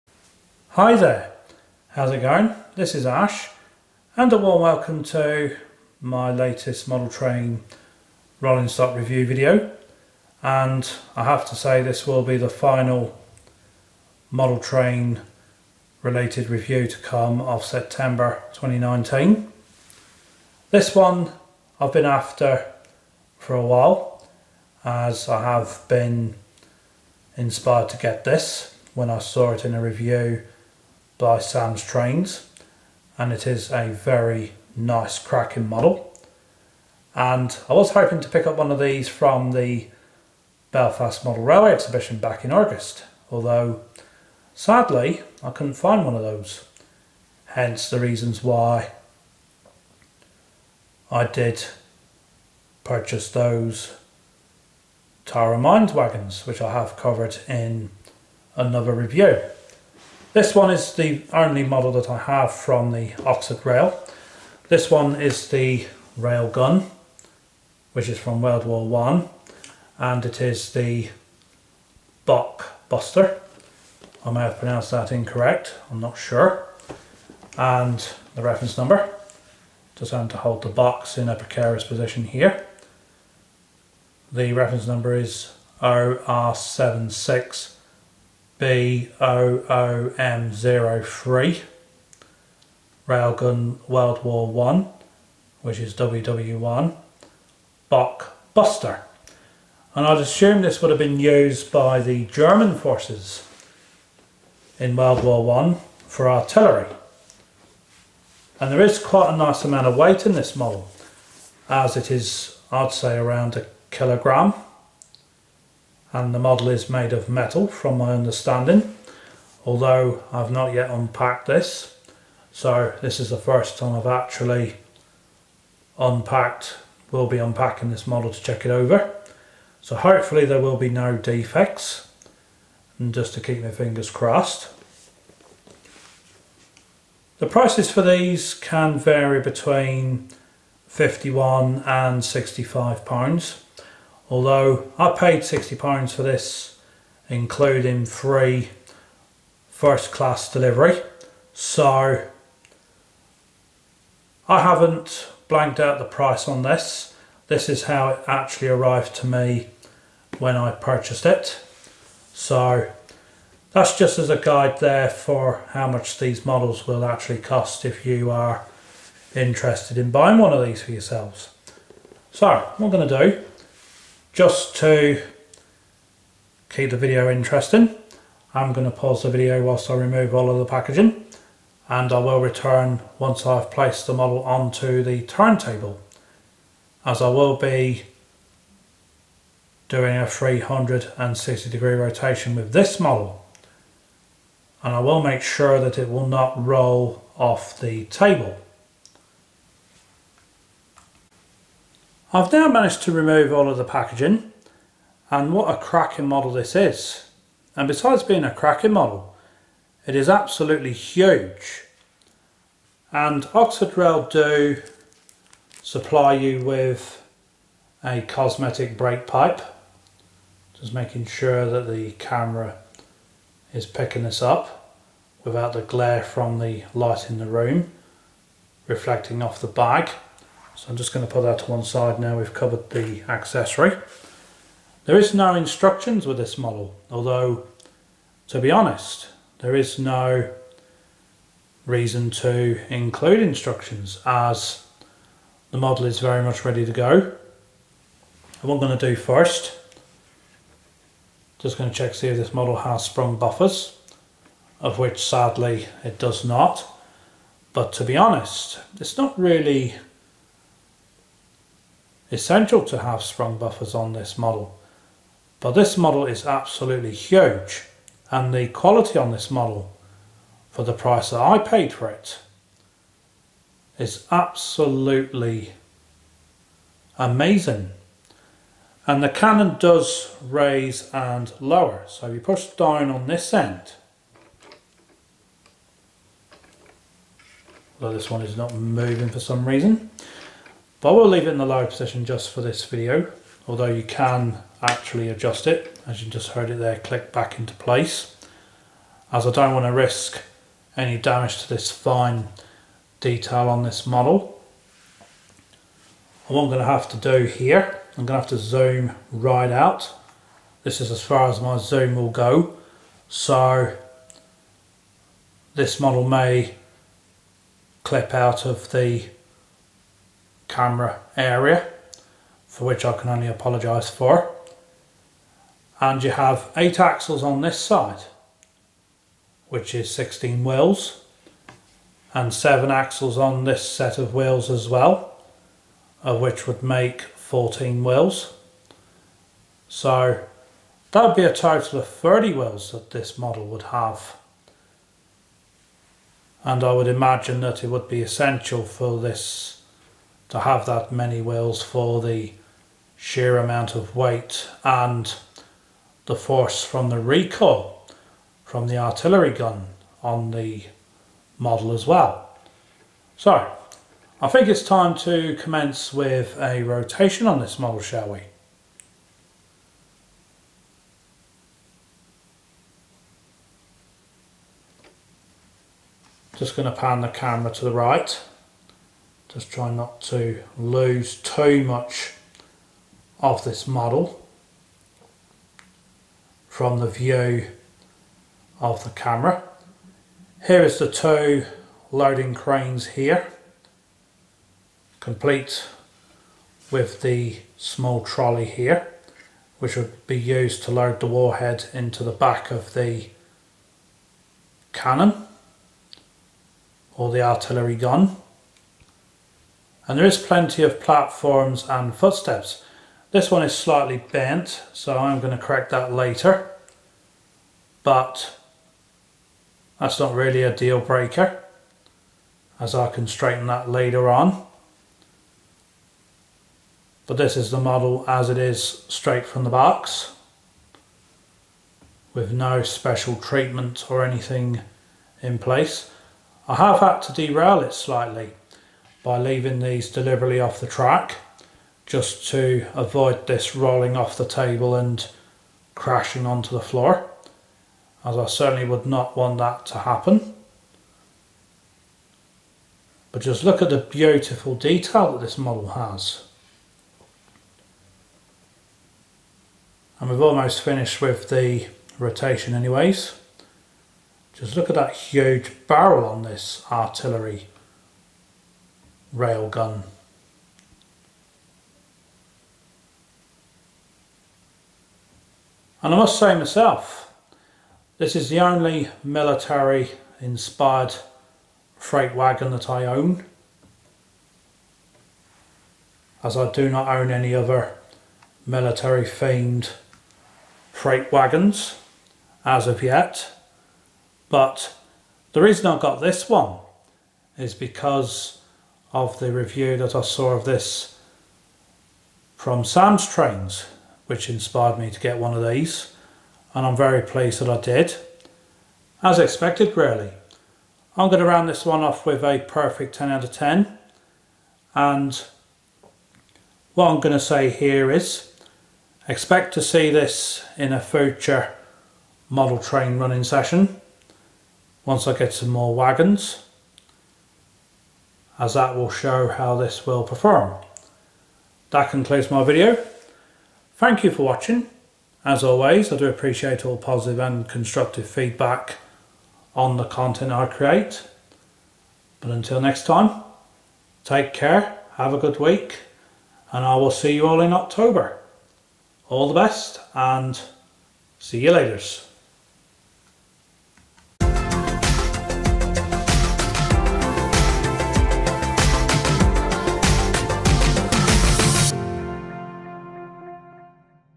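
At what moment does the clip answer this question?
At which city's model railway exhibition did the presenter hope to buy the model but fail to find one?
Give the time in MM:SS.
00:40.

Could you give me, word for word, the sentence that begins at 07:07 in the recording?
But this is the model as it is straight from the box, with no special treatment or anything in place.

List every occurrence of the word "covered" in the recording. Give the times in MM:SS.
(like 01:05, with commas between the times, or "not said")
00:56, 03:52.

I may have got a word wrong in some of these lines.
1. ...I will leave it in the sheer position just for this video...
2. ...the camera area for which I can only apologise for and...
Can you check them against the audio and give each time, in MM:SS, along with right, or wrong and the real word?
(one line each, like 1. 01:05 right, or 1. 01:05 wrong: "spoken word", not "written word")
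1. 04:51 wrong: "lower", not "sheer"
2. 05:18 right.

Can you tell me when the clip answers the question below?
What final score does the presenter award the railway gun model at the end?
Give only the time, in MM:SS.
08:33.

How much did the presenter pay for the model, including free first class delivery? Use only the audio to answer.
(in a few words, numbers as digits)
£60.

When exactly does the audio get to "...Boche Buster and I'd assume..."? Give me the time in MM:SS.
01:37.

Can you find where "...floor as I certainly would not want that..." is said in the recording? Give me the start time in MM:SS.
07:26.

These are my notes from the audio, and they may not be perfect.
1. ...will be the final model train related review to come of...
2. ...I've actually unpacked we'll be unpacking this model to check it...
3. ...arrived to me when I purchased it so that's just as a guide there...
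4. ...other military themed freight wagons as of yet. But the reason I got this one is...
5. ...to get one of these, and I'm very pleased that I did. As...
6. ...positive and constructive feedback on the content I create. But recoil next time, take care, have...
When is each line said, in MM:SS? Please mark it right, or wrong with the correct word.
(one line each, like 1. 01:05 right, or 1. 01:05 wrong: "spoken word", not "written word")
1. 00:12 right
2. 02:03 right
3. 02:38 right
4. 08:07 right
5. 08:25 right
6. 08:56 wrong: "until", not "recoil".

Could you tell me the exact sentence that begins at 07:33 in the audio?
But just look at the beautiful detail that this model has.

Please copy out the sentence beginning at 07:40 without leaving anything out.
And we've almost finished with the rotation anyways.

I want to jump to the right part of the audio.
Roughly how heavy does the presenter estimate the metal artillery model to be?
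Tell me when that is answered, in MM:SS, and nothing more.
01:53.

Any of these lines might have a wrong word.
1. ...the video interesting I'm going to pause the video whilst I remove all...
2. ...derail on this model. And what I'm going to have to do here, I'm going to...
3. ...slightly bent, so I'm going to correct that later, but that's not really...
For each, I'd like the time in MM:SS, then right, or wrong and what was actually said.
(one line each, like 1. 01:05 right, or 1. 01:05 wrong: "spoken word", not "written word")
1. 02:56 right
2. 05:03 wrong: "detail", not "derail"
3. 06:53 right.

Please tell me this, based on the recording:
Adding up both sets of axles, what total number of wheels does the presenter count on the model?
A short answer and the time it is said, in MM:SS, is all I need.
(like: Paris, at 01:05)
30, at 05:42.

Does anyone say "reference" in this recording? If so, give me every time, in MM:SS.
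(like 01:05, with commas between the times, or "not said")
01:18, 01:24.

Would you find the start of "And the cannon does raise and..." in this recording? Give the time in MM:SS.
04:39.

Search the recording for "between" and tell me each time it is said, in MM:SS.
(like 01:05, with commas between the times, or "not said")
02:19.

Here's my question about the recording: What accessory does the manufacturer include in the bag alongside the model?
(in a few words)
cosmetic brake pipe.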